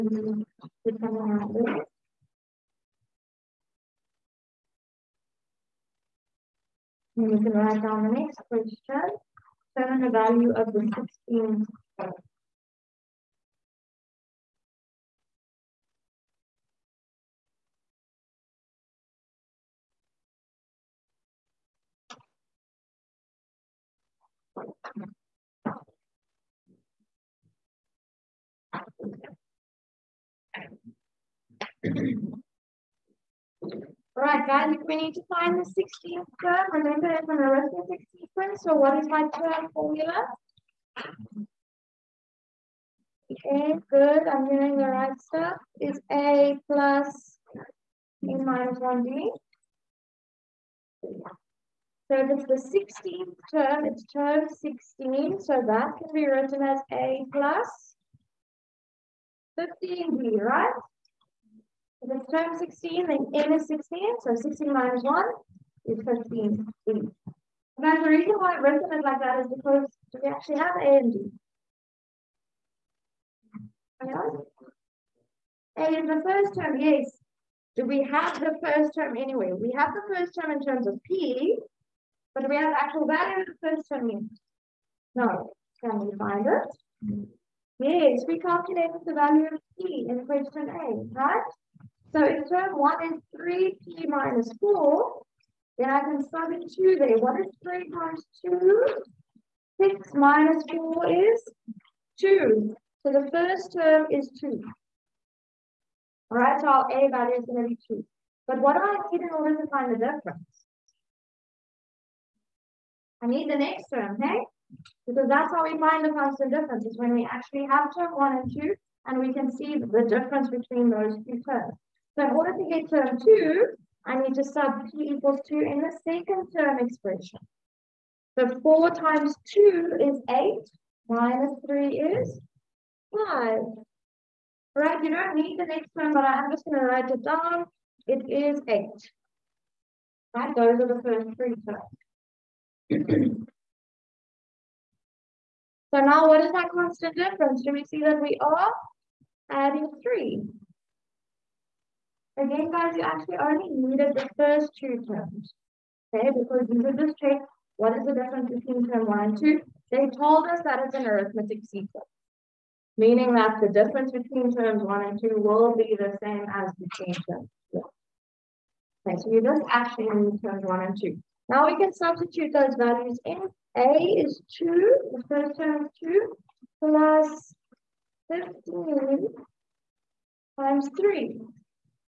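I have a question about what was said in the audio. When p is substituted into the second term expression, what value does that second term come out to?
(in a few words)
5.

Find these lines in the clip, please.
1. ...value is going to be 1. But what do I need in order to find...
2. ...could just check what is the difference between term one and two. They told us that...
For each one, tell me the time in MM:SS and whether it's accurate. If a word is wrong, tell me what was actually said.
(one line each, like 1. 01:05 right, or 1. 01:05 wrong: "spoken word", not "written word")
1. 01:47 wrong: "2", not "1"
2. 02:36 right.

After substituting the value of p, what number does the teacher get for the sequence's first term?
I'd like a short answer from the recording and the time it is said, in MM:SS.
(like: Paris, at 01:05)
2, at 01:43.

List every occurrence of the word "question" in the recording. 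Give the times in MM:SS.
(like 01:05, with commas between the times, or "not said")
00:08, 01:30.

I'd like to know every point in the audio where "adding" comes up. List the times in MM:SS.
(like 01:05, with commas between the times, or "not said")
02:29.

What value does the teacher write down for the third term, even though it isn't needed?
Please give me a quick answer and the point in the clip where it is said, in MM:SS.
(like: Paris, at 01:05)
8, at 02:18.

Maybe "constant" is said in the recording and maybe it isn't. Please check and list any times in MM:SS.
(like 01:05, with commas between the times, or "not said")
01:56, 02:26.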